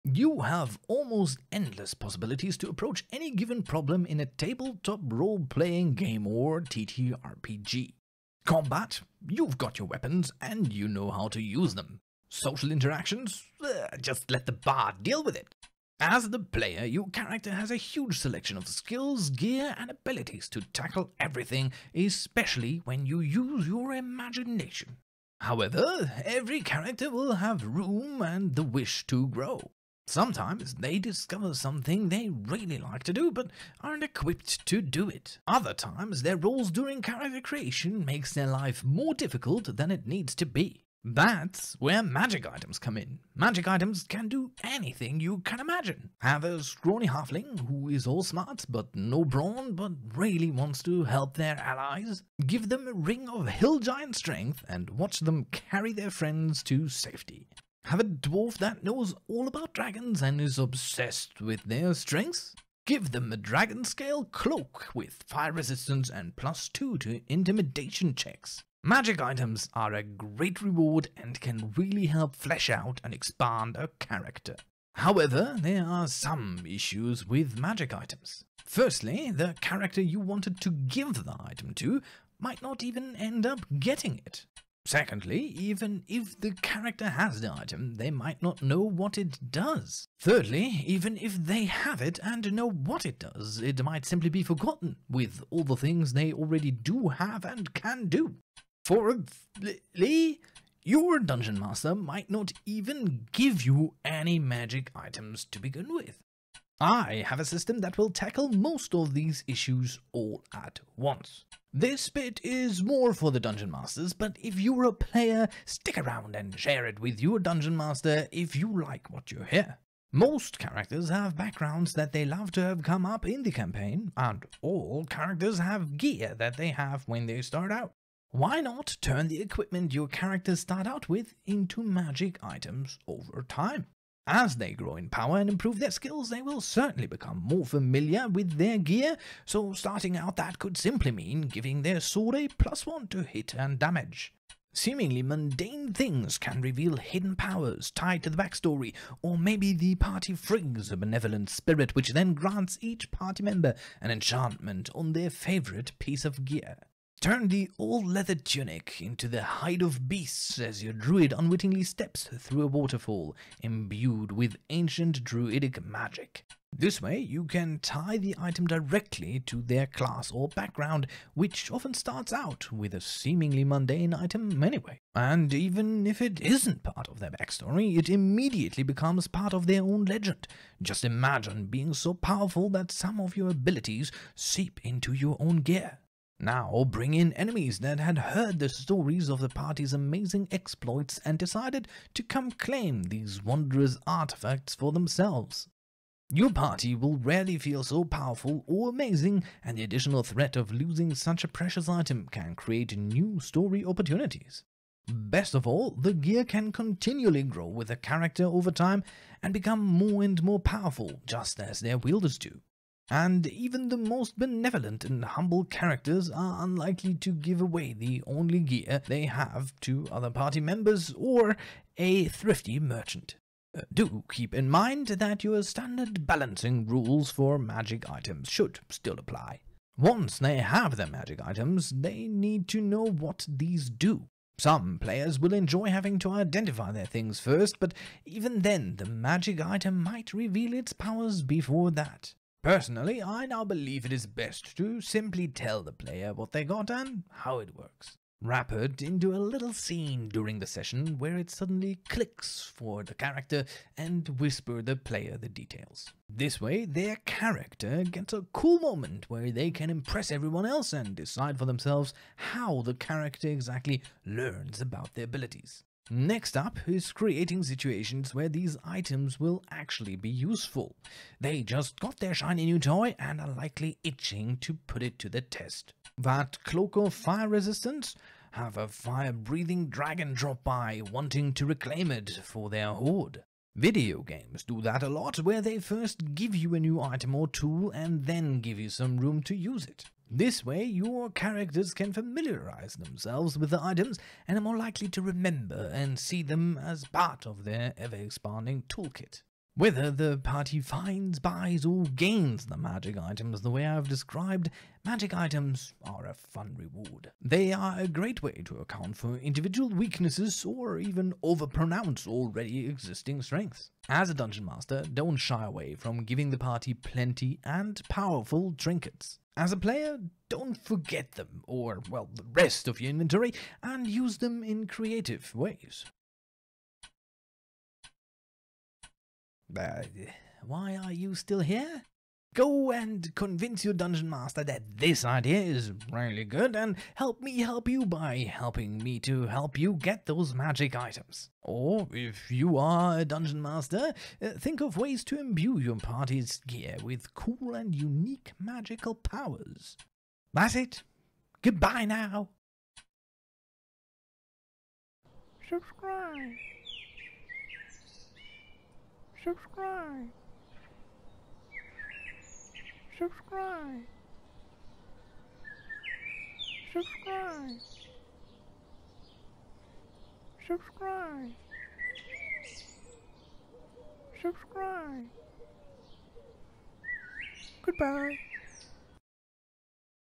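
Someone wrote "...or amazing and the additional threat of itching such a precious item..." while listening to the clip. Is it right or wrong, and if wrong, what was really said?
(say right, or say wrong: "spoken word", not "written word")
wrong: "losing", not "itching".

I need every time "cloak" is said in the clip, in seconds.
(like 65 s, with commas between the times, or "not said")
64 s, 276 s.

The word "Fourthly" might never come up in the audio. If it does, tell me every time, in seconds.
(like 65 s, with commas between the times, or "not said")
98 s.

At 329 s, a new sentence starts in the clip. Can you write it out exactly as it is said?
Uh, why are you still here?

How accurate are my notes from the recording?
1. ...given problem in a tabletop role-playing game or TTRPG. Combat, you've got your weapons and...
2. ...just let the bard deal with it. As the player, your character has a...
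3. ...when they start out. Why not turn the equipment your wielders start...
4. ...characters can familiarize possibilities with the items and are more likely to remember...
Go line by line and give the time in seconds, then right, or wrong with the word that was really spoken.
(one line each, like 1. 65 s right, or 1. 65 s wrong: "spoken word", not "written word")
1. 3 s right
2. 14 s right
3. 127 s wrong: "characters", not "wielders"
4. 291 s wrong: "themselves", not "possibilities".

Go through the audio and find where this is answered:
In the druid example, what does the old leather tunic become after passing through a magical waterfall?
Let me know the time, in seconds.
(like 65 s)
159 s.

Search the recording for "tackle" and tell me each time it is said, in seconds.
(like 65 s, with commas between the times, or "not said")
20 s, 108 s.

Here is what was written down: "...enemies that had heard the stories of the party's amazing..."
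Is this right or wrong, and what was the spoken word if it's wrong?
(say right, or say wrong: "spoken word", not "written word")
right.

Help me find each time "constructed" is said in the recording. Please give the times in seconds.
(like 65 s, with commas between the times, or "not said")
not said.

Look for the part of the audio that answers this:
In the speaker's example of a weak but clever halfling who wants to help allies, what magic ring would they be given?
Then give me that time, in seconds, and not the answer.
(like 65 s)
52 s.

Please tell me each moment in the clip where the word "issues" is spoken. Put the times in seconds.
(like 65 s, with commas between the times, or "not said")
76 s, 109 s.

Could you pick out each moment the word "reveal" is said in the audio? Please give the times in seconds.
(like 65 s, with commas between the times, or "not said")
146 s, 240 s.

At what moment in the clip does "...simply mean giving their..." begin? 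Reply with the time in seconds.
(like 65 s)
140 s.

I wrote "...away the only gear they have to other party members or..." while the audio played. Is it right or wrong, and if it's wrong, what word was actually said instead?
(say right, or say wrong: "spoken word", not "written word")
right.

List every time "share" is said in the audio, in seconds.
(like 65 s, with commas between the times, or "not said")
116 s.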